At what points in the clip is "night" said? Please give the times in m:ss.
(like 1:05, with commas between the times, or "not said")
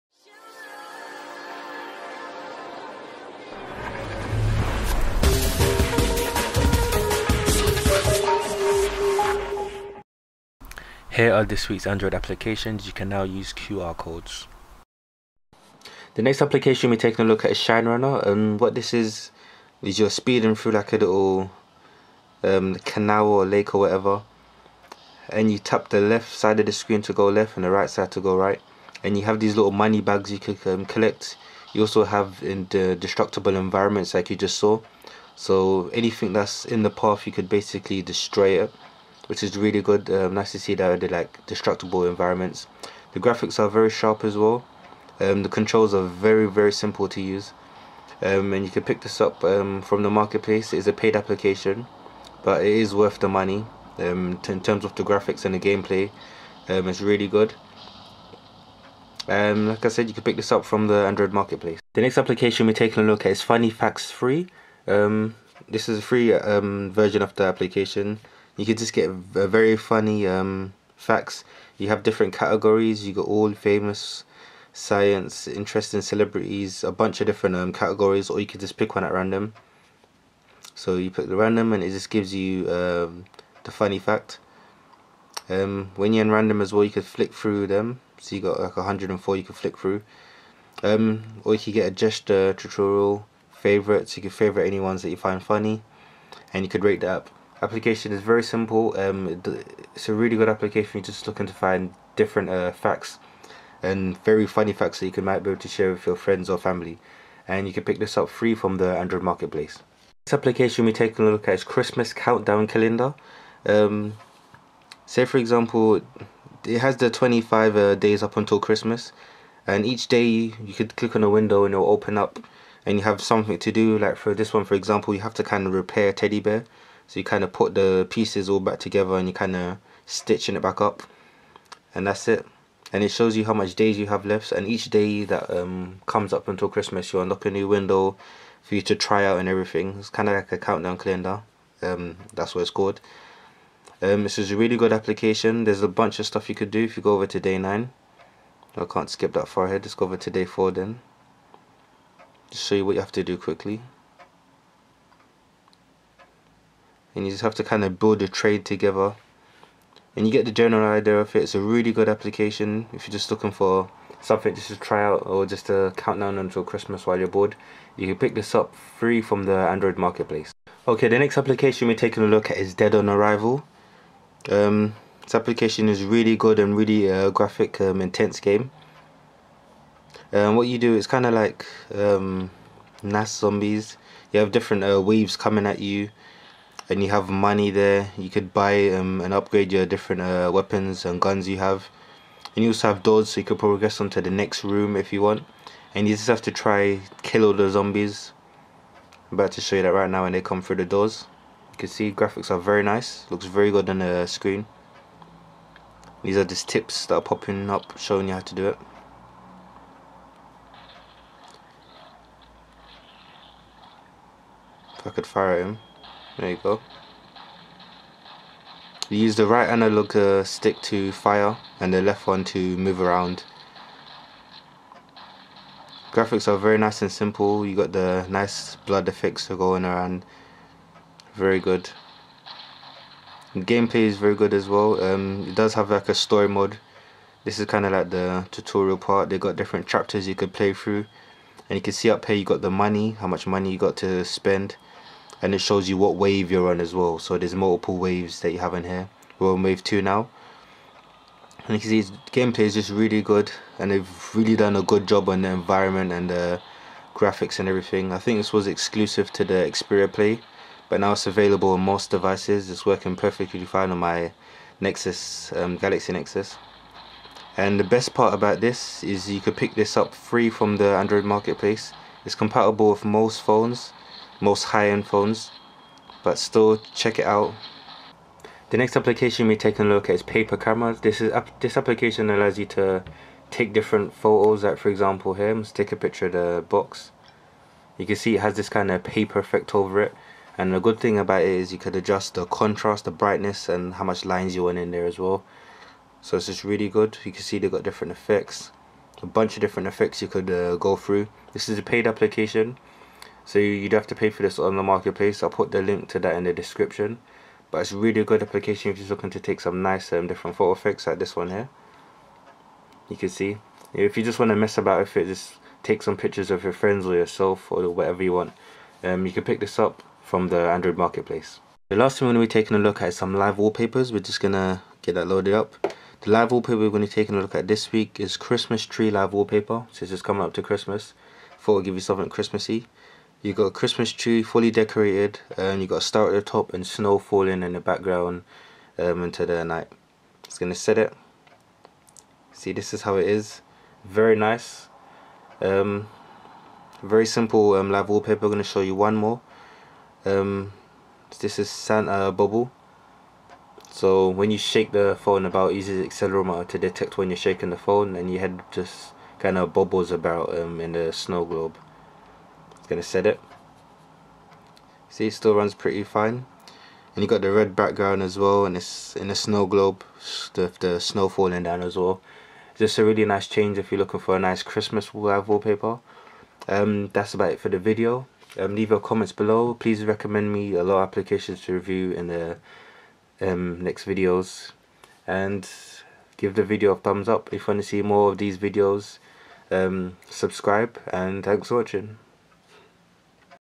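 5:39.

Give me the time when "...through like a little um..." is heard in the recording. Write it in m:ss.
0:20.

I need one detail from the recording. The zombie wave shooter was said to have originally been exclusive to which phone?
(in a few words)
Xperia Play.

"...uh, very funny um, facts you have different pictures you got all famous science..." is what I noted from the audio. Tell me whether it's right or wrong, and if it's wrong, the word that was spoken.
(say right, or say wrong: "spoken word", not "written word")
wrong: "categories", not "pictures".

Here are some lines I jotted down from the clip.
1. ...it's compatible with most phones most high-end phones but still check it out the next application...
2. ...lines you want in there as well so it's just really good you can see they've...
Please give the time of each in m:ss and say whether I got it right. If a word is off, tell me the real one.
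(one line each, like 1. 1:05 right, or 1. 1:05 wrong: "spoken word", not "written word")
1. 4:32 right
2. 4:54 right.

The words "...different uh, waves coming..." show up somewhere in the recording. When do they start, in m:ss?
3:04.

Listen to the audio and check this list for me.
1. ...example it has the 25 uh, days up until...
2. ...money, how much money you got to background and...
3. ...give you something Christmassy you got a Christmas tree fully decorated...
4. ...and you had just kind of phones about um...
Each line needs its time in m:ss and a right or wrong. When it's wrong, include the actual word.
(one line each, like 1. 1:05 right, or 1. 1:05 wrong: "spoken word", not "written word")
1. 1:55 right
2. 4:02 wrong: "spend", not "background"
3. 5:31 right
4. 5:58 wrong: "bubbles", not "phones".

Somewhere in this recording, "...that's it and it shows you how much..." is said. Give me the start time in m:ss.
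2:12.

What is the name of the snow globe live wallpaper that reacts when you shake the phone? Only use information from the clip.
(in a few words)
Santa Bobble.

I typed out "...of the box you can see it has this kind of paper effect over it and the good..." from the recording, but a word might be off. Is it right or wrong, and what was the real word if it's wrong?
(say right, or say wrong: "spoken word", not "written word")
right.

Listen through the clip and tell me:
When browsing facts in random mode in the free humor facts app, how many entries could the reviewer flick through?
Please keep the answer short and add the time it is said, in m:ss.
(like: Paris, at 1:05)
104, at 1:28.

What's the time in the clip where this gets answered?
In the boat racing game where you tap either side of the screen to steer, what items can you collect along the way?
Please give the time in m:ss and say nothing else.
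0:29.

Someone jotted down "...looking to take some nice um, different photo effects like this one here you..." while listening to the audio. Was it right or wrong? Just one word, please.
right.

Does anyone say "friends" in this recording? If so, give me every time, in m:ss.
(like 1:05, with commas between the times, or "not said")
1:46, 5:16.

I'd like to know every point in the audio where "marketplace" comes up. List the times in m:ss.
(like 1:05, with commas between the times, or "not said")
0:50, 1:01, 1:49, 2:49, 4:31, 5:04, 5:20.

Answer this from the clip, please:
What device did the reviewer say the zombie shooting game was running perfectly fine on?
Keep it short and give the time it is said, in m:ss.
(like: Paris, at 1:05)
Galaxy Nexus, at 4:25.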